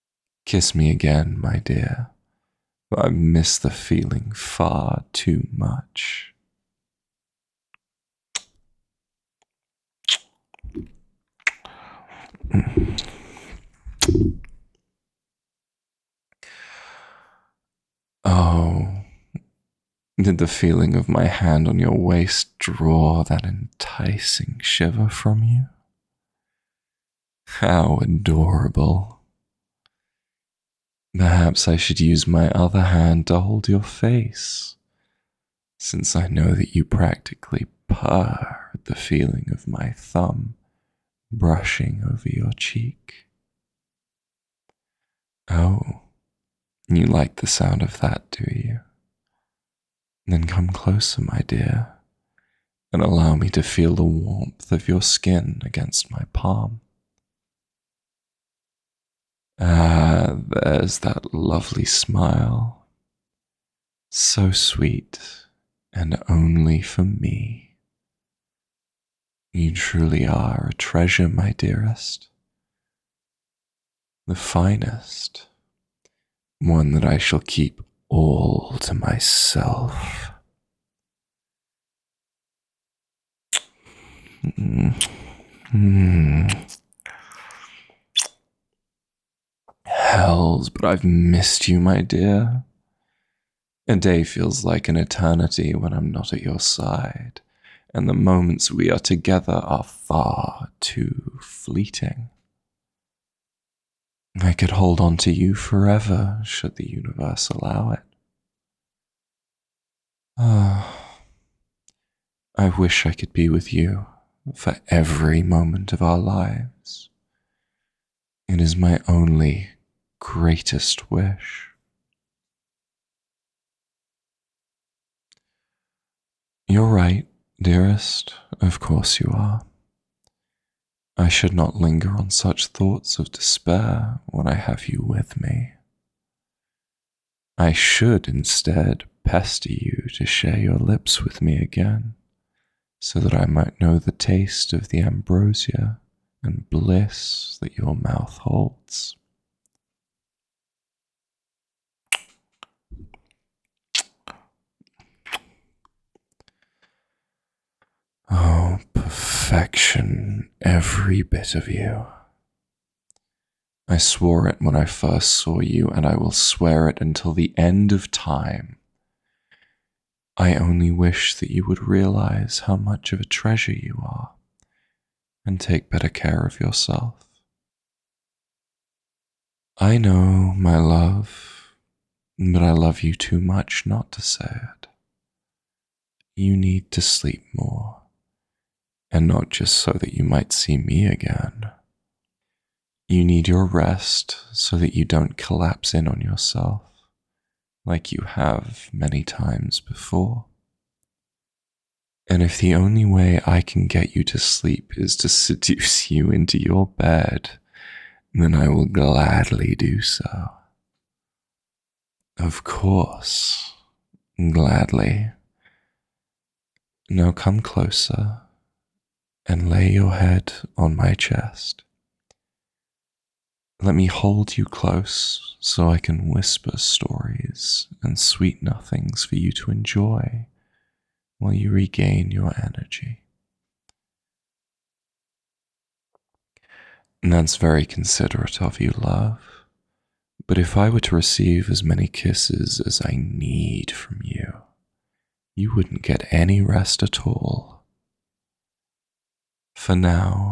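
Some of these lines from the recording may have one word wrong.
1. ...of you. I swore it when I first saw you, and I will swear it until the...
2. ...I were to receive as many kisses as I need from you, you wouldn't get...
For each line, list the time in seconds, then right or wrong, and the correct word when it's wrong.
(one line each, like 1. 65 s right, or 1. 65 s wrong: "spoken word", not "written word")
1. 161 s right
2. 240 s right.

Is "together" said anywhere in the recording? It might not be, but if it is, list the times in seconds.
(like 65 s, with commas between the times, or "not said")
98 s.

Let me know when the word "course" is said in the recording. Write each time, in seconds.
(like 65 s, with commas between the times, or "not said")
128 s, 212 s.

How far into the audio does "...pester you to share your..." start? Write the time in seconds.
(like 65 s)
139 s.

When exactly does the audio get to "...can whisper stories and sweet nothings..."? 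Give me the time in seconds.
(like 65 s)
225 s.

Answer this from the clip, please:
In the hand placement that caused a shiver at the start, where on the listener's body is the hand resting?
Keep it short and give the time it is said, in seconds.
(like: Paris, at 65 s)
waist, at 21 s.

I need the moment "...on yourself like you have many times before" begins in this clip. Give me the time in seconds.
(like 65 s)
196 s.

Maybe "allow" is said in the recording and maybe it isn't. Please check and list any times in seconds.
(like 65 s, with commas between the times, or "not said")
53 s, 107 s.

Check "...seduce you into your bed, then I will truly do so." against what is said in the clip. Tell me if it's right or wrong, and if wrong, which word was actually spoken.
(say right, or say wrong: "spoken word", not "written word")
wrong: "gladly", not "truly".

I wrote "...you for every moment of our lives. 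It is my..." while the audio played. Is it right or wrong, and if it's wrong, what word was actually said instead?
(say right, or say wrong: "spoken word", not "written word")
right.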